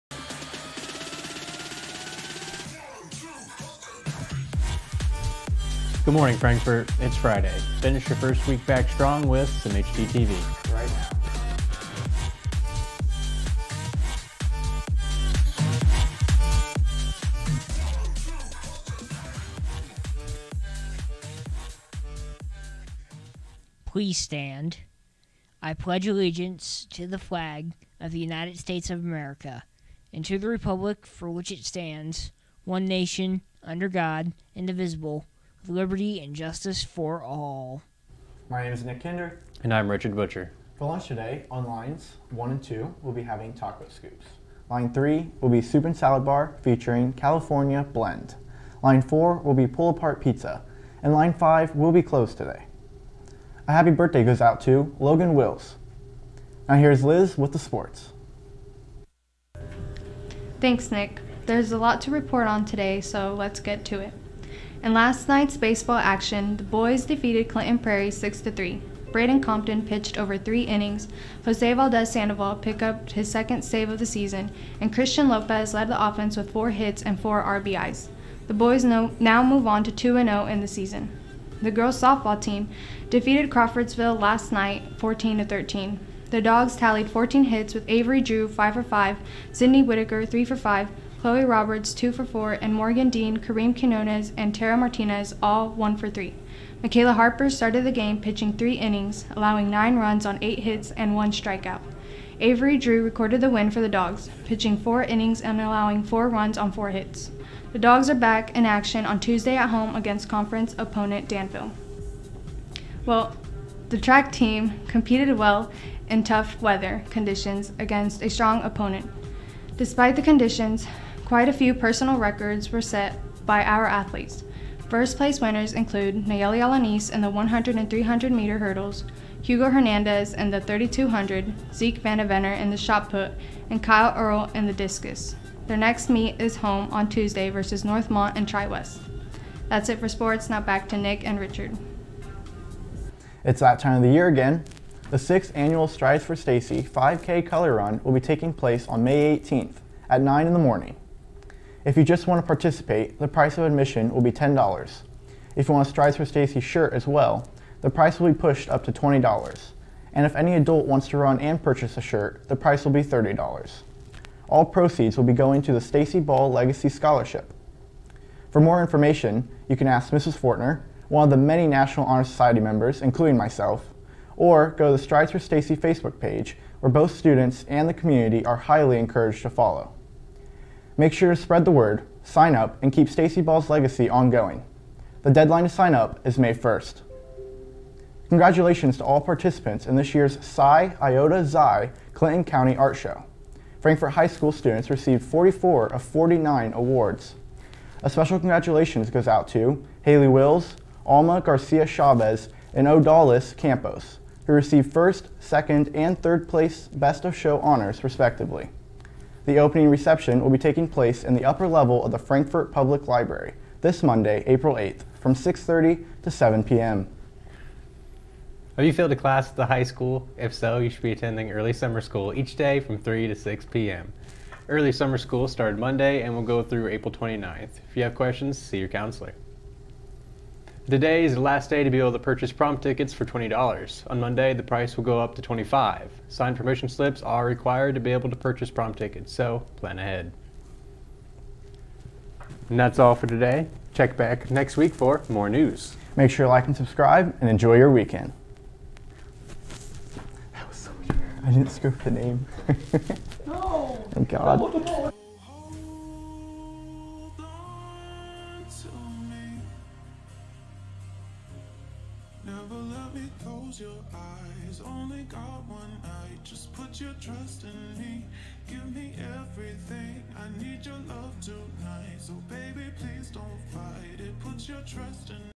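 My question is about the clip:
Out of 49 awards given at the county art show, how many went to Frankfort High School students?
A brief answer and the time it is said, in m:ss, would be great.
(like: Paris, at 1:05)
44, at 3:15.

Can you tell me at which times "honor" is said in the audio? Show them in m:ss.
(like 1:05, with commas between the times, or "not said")
2:52, 3:27.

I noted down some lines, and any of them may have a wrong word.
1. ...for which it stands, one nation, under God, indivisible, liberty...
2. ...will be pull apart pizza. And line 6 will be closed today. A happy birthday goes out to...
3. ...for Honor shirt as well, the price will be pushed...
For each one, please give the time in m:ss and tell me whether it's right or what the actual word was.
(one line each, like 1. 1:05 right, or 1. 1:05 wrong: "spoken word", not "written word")
1. 0:31 right
2. 0:49 wrong: "5", not "6"
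3. 2:36 wrong: "Stacy", not "Honor".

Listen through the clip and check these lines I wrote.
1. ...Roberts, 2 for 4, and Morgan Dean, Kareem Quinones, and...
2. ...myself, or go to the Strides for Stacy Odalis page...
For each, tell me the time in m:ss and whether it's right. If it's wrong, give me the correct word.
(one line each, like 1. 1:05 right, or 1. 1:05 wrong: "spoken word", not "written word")
1. 1:31 right
2. 2:53 wrong: "Facebook", not "Odalis".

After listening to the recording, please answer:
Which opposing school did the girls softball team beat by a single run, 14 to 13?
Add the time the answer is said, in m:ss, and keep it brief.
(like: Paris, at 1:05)
Crawfordsville, at 1:23.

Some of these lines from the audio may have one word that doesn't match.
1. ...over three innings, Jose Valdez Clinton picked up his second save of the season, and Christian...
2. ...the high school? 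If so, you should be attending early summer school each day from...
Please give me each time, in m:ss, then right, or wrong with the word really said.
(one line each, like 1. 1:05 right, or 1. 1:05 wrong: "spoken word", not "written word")
1. 1:10 wrong: "Sandoval", not "Clinton"
2. 3:39 right.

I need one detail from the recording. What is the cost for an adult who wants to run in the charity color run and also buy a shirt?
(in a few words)
$30.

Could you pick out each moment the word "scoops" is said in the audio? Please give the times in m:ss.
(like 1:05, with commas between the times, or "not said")
0:43, 4:11.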